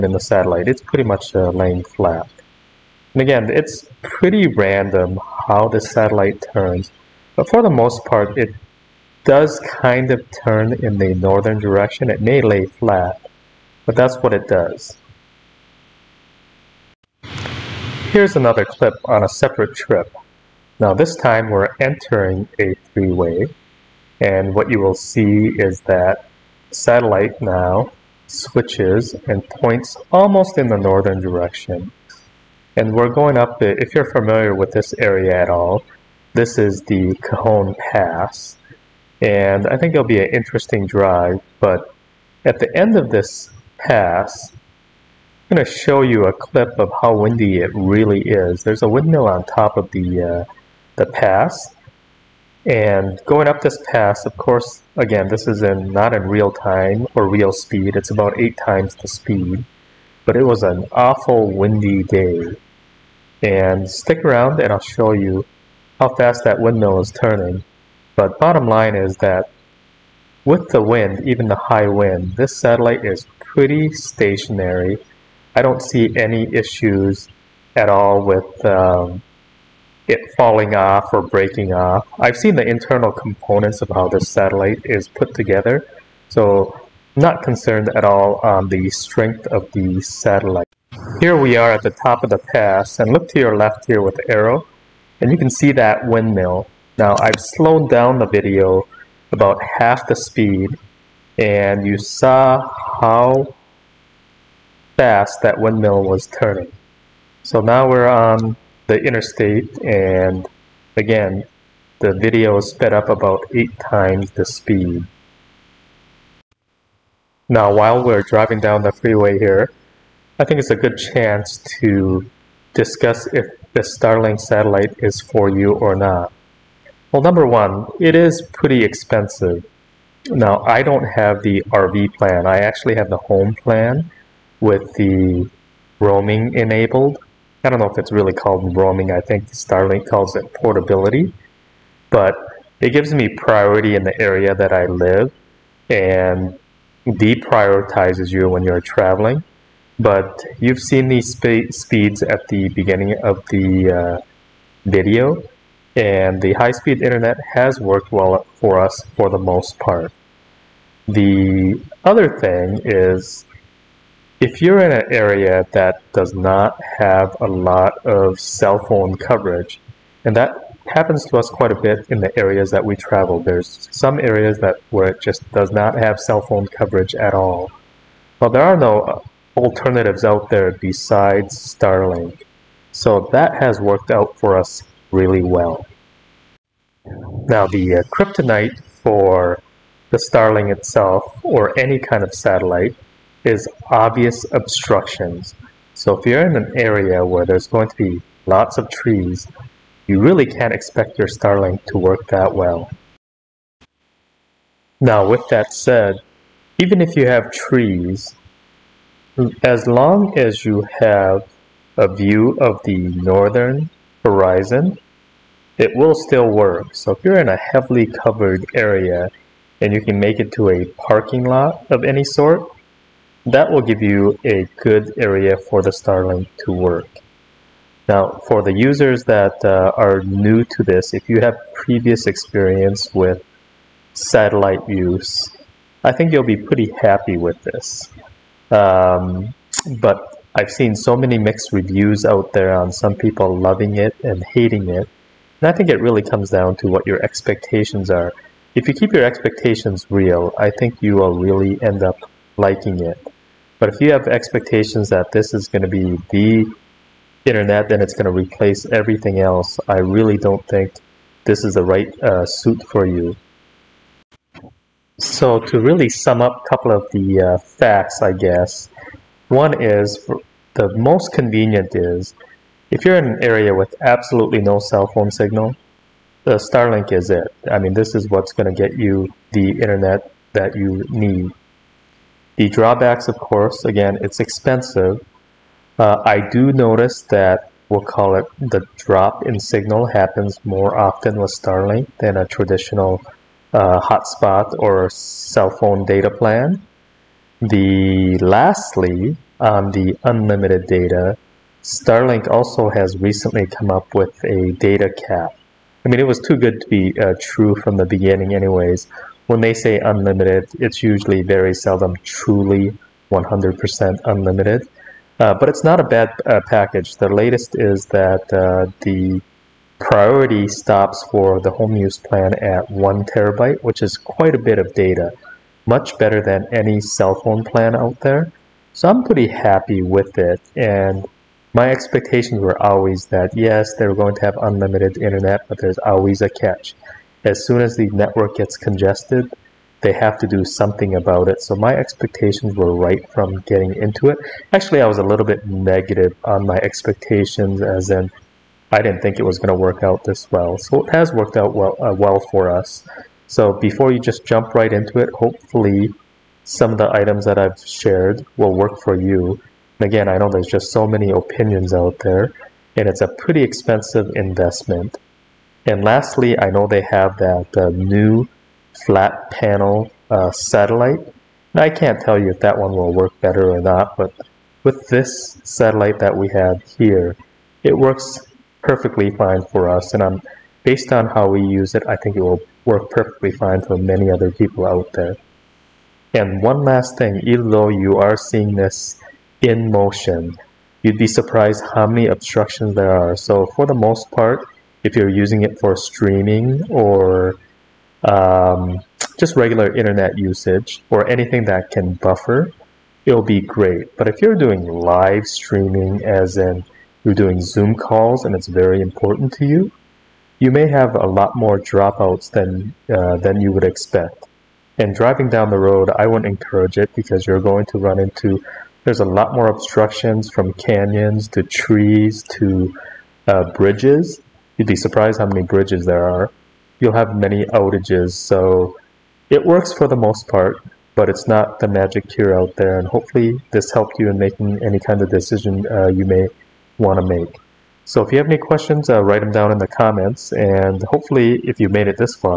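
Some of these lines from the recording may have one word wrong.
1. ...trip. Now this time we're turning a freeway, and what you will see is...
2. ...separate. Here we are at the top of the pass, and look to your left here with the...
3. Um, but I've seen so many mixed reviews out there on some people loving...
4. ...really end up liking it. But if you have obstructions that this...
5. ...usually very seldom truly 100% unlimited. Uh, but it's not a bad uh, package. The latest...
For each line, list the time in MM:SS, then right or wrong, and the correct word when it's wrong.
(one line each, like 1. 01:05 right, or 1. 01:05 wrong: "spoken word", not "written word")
1. 00:19 wrong: "entering", not "turning"
2. 01:30 wrong: "satellite", not "separate"
3. 03:58 right
4. 04:11 wrong: "expectations", not "obstructions"
5. 05:11 right.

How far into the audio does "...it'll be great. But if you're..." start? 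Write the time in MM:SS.
06:43.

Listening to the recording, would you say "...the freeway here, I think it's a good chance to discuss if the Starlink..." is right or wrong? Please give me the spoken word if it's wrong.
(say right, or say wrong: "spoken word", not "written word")
right.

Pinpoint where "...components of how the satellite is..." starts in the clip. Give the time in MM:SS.
01:23.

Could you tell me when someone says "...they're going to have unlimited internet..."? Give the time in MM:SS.
05:33.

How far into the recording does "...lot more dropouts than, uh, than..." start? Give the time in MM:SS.
06:51.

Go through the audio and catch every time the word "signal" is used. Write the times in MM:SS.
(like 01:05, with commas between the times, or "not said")
04:35, 04:49.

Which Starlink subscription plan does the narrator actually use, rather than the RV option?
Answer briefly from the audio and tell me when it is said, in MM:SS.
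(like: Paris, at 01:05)
Home plan, at 02:13.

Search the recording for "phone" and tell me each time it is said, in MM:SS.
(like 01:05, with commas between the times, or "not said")
02:48, 02:56, 04:35, 04:55, 05:27.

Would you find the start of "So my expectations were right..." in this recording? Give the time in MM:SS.
05:41.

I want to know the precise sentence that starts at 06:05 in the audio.
And lastly, I know they have that uh, new flat panel uh, satellite.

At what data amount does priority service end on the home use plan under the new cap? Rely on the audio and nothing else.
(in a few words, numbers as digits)
1 terabyte.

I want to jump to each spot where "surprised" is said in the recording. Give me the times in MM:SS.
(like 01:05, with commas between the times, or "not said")
06:31, 07:04.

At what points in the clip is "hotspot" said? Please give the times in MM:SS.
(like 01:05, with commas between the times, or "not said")
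04:54.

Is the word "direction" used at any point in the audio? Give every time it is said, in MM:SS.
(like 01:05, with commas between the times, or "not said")
00:11, 00:31.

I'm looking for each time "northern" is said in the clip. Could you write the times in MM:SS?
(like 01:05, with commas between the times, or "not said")
00:11, 00:30, 03:32.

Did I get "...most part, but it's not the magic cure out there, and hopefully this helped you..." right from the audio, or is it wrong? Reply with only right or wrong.
right.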